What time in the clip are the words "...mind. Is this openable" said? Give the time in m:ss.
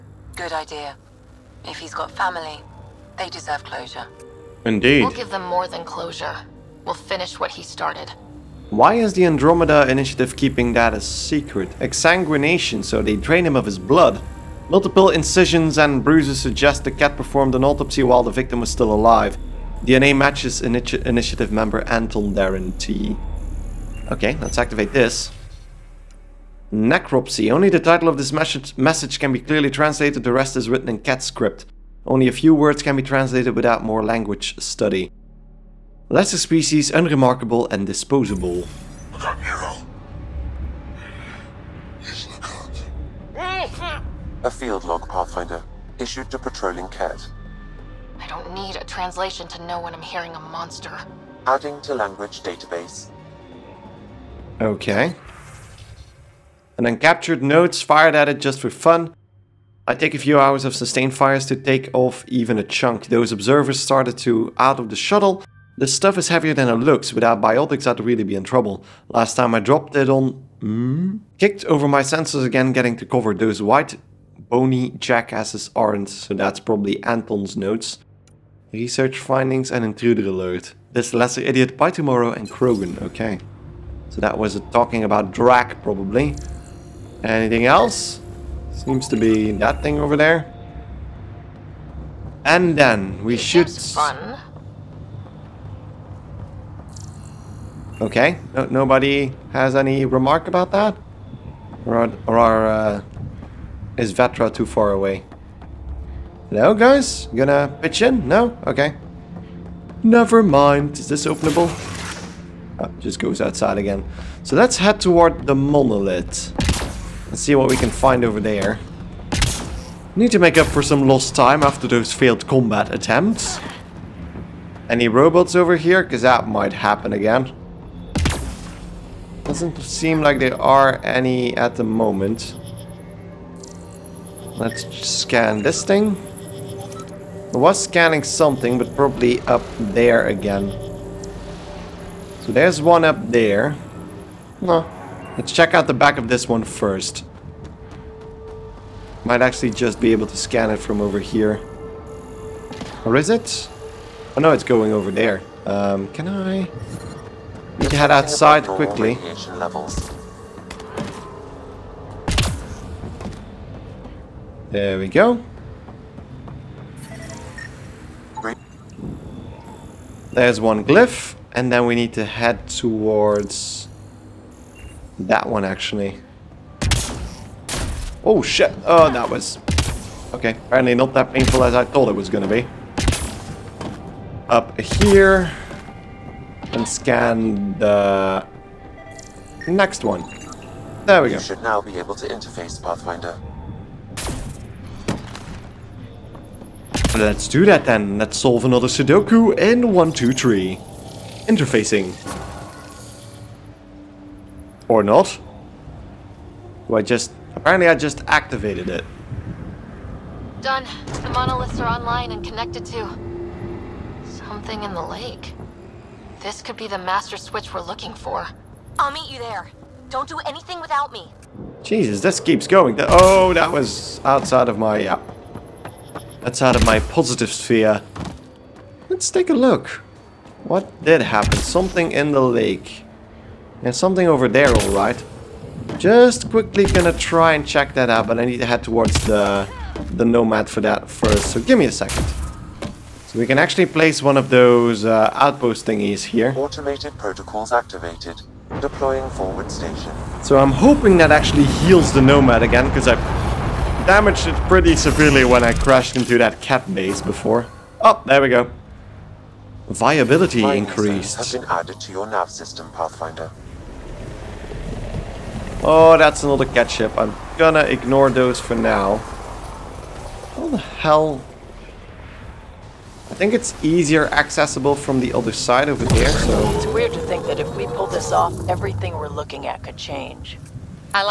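1:50.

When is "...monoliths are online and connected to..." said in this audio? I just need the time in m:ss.
3:31.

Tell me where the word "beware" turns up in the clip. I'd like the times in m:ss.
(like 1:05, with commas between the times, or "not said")
not said.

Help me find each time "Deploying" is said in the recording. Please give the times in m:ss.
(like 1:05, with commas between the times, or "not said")
4:08.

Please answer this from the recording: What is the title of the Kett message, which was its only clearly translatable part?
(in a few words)
Necropsy.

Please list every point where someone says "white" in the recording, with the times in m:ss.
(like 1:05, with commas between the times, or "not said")
1:13.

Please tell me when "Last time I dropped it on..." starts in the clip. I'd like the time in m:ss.
1:09.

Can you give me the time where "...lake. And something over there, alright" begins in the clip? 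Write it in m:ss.
3:52.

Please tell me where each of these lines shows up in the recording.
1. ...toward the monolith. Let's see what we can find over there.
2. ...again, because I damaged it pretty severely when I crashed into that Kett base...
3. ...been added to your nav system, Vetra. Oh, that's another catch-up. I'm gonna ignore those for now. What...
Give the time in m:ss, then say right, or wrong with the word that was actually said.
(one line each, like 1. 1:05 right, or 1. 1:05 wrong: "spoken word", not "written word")
1. 1:55 right
2. 4:12 right
3. 4:21 wrong: "Pathfinder", not "Vetra".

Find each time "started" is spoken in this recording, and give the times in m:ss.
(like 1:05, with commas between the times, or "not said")
0:07, 1:03.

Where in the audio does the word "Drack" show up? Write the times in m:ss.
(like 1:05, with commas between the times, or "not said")
1:25.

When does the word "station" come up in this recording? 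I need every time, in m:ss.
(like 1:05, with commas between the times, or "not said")
4:09.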